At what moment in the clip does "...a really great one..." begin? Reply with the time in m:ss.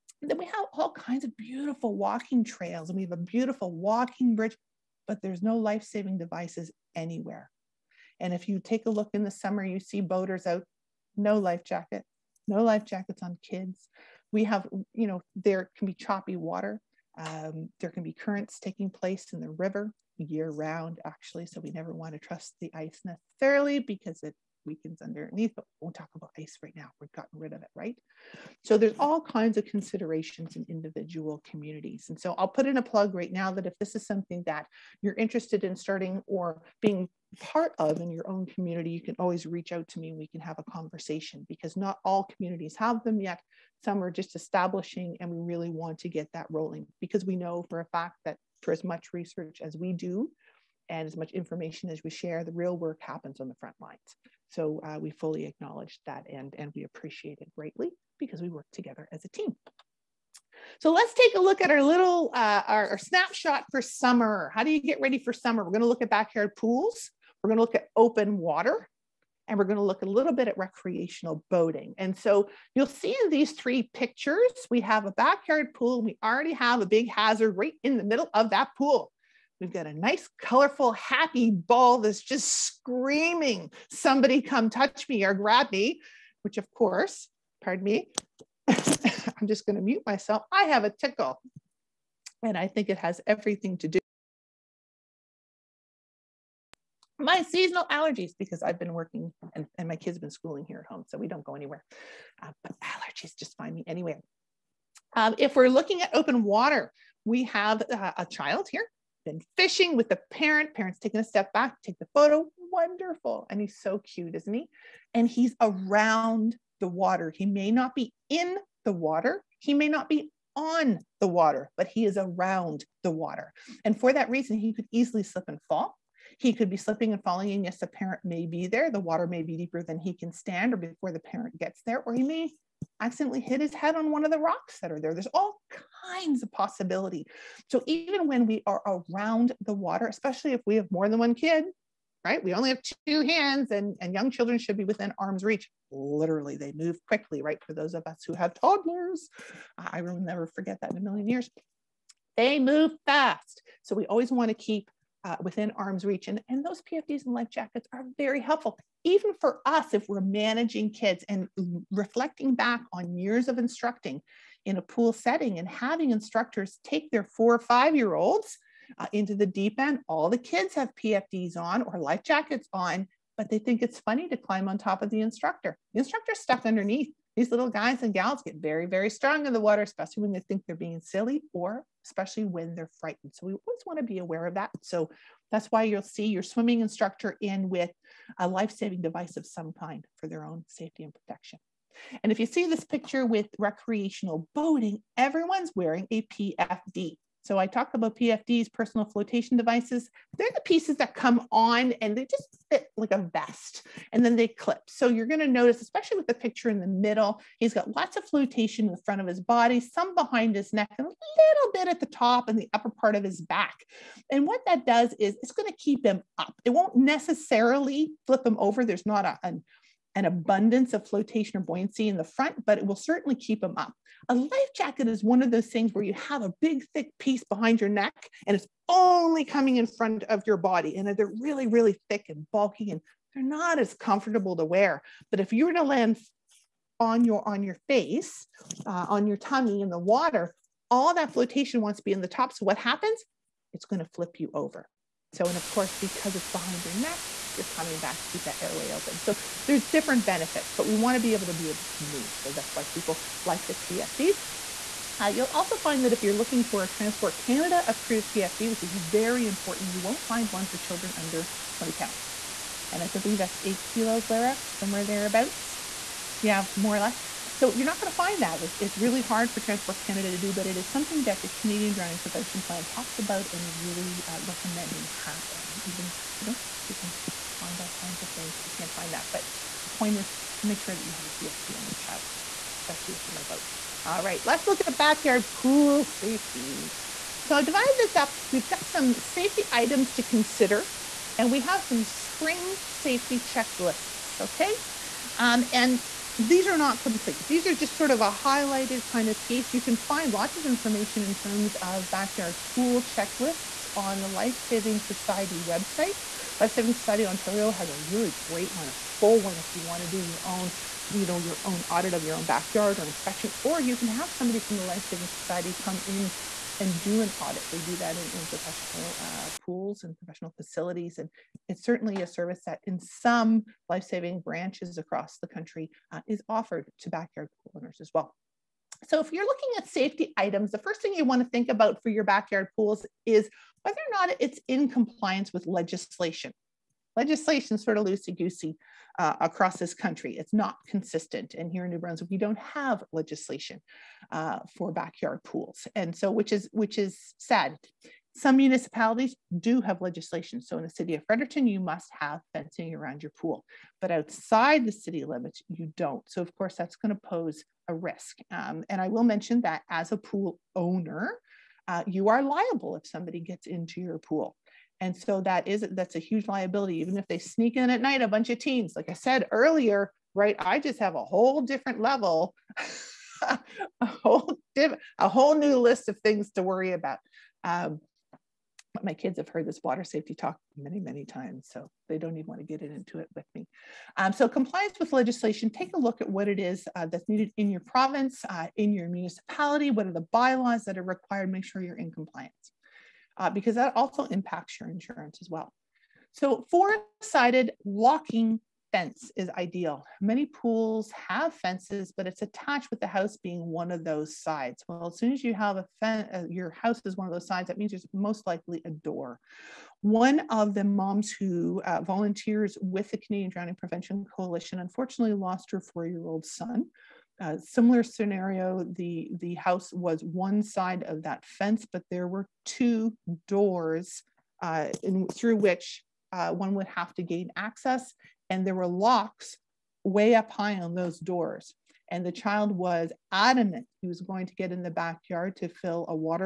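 5:07.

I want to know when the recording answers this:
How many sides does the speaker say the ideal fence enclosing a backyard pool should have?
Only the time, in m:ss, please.
6:36.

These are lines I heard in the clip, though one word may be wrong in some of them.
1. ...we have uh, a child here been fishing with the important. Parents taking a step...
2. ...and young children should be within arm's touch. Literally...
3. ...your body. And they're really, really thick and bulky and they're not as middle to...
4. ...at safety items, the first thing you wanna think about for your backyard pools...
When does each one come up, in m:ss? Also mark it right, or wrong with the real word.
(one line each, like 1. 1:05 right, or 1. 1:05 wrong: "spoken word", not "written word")
1. 1:47 wrong: "parent", not "important"
2. 2:24 wrong: "reach", not "touch"
3. 3:50 wrong: "comfortable", not "middle"
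4. 5:29 right.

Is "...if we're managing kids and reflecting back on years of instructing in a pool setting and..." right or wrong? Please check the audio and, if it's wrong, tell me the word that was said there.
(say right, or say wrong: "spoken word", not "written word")
right.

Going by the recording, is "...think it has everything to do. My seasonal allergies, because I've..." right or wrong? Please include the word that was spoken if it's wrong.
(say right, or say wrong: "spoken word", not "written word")
right.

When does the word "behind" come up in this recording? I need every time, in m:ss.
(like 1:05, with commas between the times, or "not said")
3:30, 3:47, 4:06.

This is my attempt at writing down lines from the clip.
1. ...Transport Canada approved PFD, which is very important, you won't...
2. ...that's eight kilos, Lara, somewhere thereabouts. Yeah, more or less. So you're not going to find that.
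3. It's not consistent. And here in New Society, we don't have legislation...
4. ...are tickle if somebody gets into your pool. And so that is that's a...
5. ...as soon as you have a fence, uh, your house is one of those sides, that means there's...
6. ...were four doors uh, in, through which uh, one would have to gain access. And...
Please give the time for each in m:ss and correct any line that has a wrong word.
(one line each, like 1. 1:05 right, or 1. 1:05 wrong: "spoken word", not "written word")
1. 4:16 right
2. 4:23 right
3. 5:40 wrong: "Brunswick", not "Society"
4. 6:02 wrong: "liable", not "tickle"
5. 6:45 right
6. 7:02 wrong: "two", not "four".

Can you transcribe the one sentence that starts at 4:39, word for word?
But the point is to make sure that you have a PFD on your child, especially if you're a boat.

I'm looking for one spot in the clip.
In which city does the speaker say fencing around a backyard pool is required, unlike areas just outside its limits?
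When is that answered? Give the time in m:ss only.
5:51.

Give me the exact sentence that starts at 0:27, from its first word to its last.
We've gotten rid of it, right?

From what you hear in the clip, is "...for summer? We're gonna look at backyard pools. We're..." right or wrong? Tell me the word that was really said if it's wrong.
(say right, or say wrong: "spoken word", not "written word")
right.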